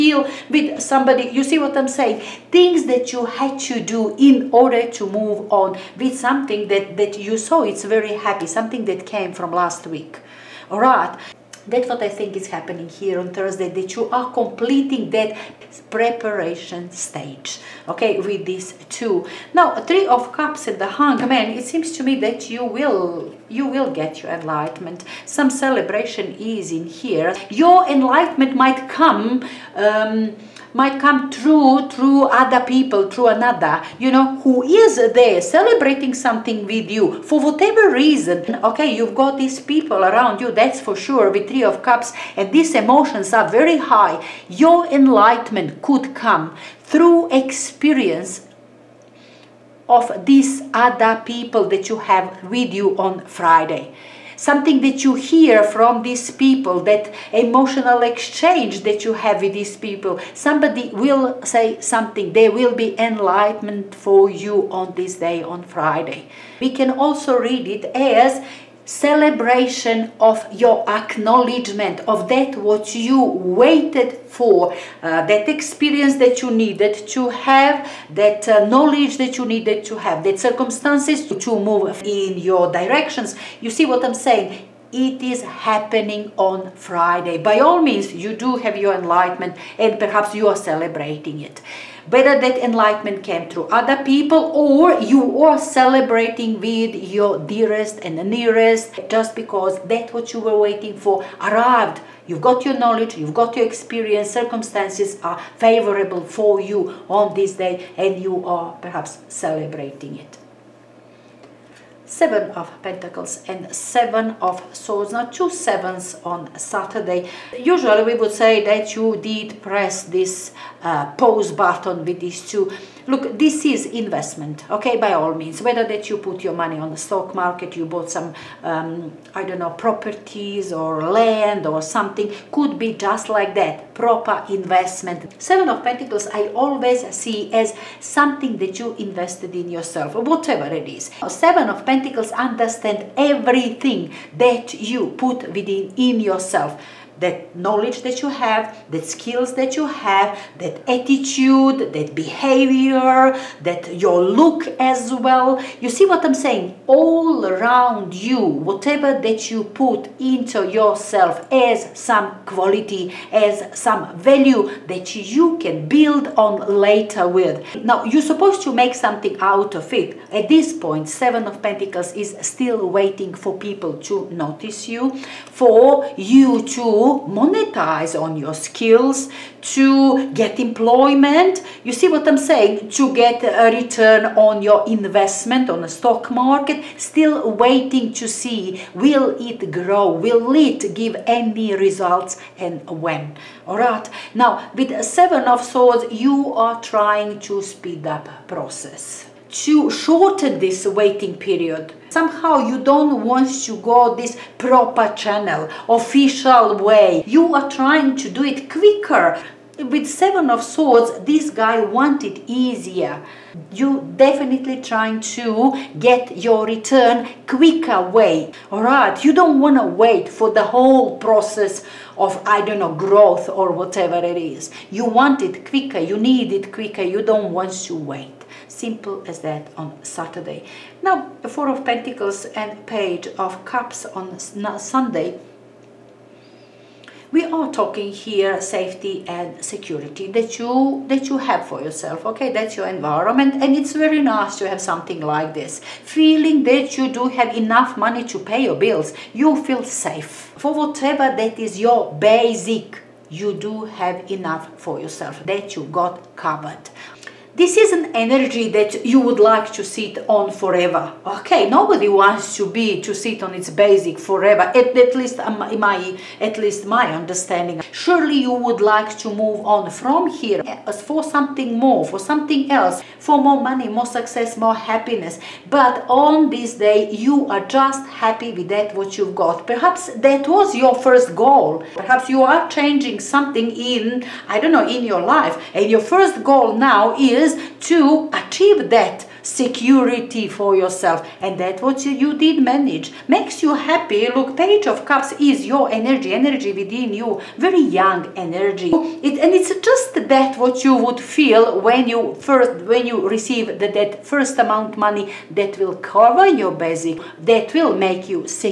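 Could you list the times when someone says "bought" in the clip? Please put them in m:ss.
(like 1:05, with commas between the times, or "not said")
2:07.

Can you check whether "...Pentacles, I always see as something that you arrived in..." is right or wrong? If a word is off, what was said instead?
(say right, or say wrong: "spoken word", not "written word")
wrong: "invested", not "arrived".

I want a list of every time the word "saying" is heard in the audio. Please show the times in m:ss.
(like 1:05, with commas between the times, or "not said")
0:01, 1:24, 2:36, 3:02.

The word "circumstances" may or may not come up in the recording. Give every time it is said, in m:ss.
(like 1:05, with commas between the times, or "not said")
1:20, 1:44.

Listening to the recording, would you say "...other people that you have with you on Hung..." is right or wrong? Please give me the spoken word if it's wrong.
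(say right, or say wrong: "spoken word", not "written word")
wrong: "Friday", not "Hung".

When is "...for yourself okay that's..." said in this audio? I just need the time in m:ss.
4:01.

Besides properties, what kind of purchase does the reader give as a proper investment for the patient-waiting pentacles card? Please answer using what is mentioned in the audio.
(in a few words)
land.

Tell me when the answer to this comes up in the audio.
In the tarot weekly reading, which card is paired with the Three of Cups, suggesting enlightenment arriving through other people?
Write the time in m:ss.
0:20.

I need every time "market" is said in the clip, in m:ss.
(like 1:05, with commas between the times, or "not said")
2:07, 3:06.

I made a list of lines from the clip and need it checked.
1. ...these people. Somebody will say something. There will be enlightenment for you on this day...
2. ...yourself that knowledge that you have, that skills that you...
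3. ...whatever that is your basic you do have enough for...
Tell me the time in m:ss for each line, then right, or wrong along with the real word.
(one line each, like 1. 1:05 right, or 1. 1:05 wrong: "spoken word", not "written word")
1. 0:59 right
2. 2:26 right
3. 4:10 right.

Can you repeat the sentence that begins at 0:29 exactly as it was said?
Um, might come true through other people, through another, you know, who is there celebrating something with you for whatever reason.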